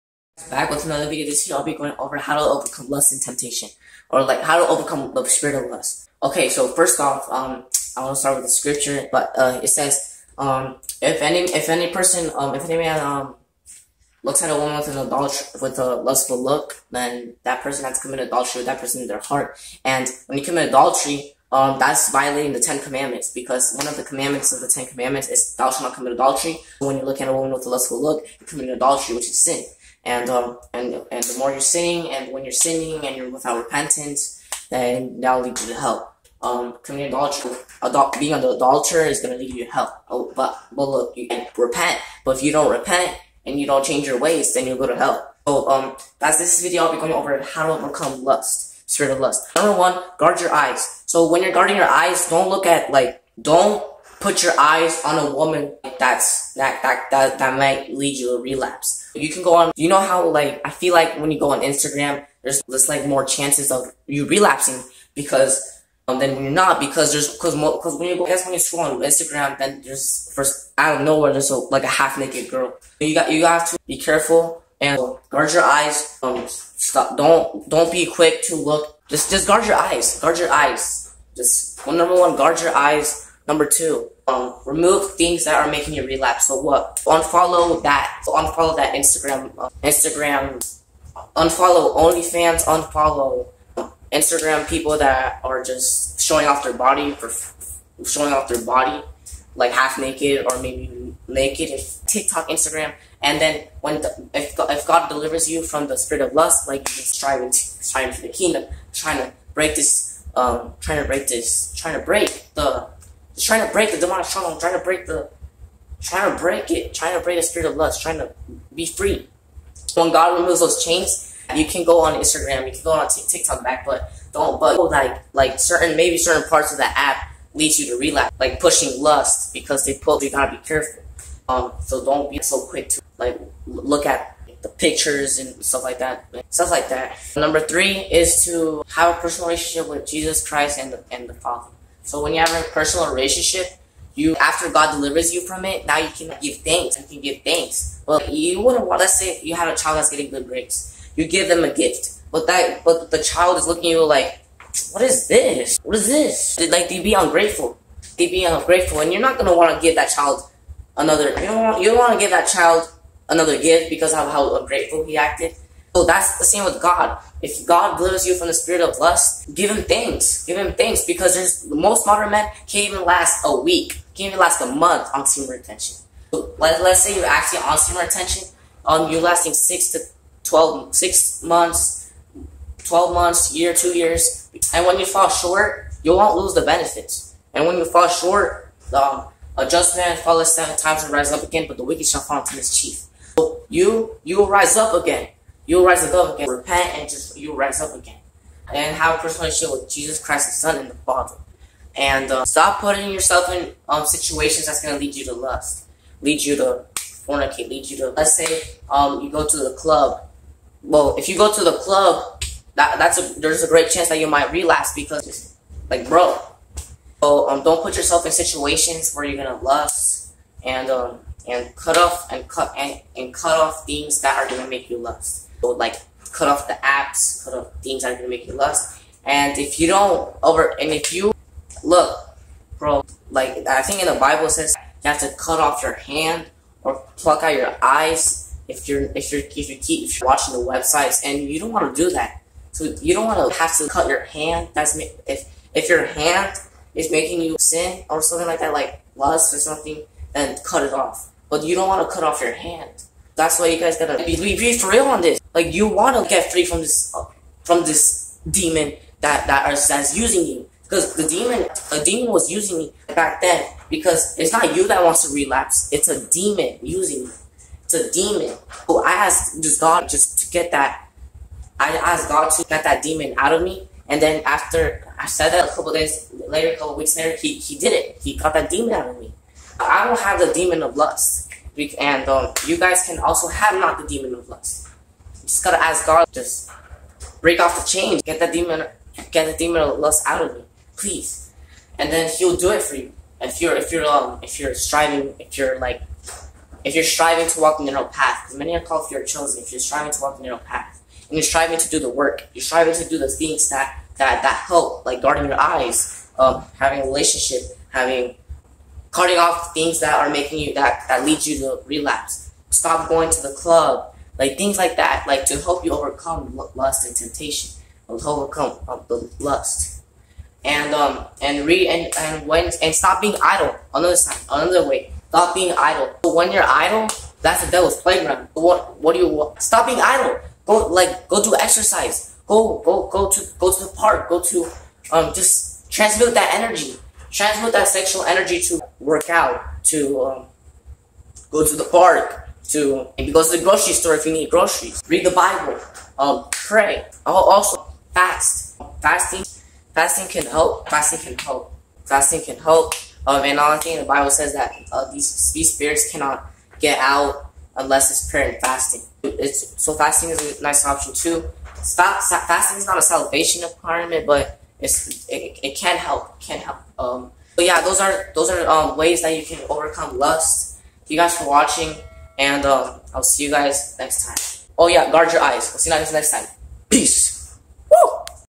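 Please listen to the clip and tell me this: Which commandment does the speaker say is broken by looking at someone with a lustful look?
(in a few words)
Thou shalt not commit adultery.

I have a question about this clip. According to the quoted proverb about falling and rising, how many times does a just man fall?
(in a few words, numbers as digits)
7.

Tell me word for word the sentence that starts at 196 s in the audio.
Repent and just you'll rise up again.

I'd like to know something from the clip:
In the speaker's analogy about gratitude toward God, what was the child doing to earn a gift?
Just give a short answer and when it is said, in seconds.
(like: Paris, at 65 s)
Getting good grades, at 150 s.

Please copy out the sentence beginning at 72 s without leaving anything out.
You got you have to be careful and guard your eyes.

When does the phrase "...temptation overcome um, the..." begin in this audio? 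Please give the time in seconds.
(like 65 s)
317 s.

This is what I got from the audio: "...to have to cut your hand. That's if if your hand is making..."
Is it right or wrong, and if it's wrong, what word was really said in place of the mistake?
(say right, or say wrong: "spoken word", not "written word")
right.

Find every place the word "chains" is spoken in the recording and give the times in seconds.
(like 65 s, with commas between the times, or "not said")
120 s, 287 s.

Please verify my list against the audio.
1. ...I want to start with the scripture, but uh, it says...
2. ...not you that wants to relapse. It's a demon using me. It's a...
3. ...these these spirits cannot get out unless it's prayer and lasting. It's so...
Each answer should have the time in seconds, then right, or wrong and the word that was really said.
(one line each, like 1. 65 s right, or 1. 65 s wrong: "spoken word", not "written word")
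1. 7 s right
2. 264 s right
3. 355 s wrong: "fasting", not "lasting".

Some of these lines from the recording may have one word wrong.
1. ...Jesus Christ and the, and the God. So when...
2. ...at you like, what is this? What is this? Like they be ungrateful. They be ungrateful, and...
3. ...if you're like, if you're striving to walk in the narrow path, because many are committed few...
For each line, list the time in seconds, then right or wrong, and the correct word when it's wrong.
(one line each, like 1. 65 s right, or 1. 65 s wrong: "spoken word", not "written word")
1. 140 s wrong: "Father", not "God"
2. 153 s right
3. 295 s wrong: "called", not "committed".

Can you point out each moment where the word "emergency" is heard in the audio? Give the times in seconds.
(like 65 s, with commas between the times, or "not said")
not said.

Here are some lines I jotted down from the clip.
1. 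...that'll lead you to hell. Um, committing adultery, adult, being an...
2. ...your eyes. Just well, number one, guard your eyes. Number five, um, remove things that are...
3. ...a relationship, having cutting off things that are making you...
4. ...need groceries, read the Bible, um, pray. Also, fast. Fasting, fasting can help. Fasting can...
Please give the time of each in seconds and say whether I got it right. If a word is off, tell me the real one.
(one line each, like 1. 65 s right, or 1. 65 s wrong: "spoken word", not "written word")
1. 35 s right
2. 80 s wrong: "two", not "five"
3. 307 s right
4. 344 s right.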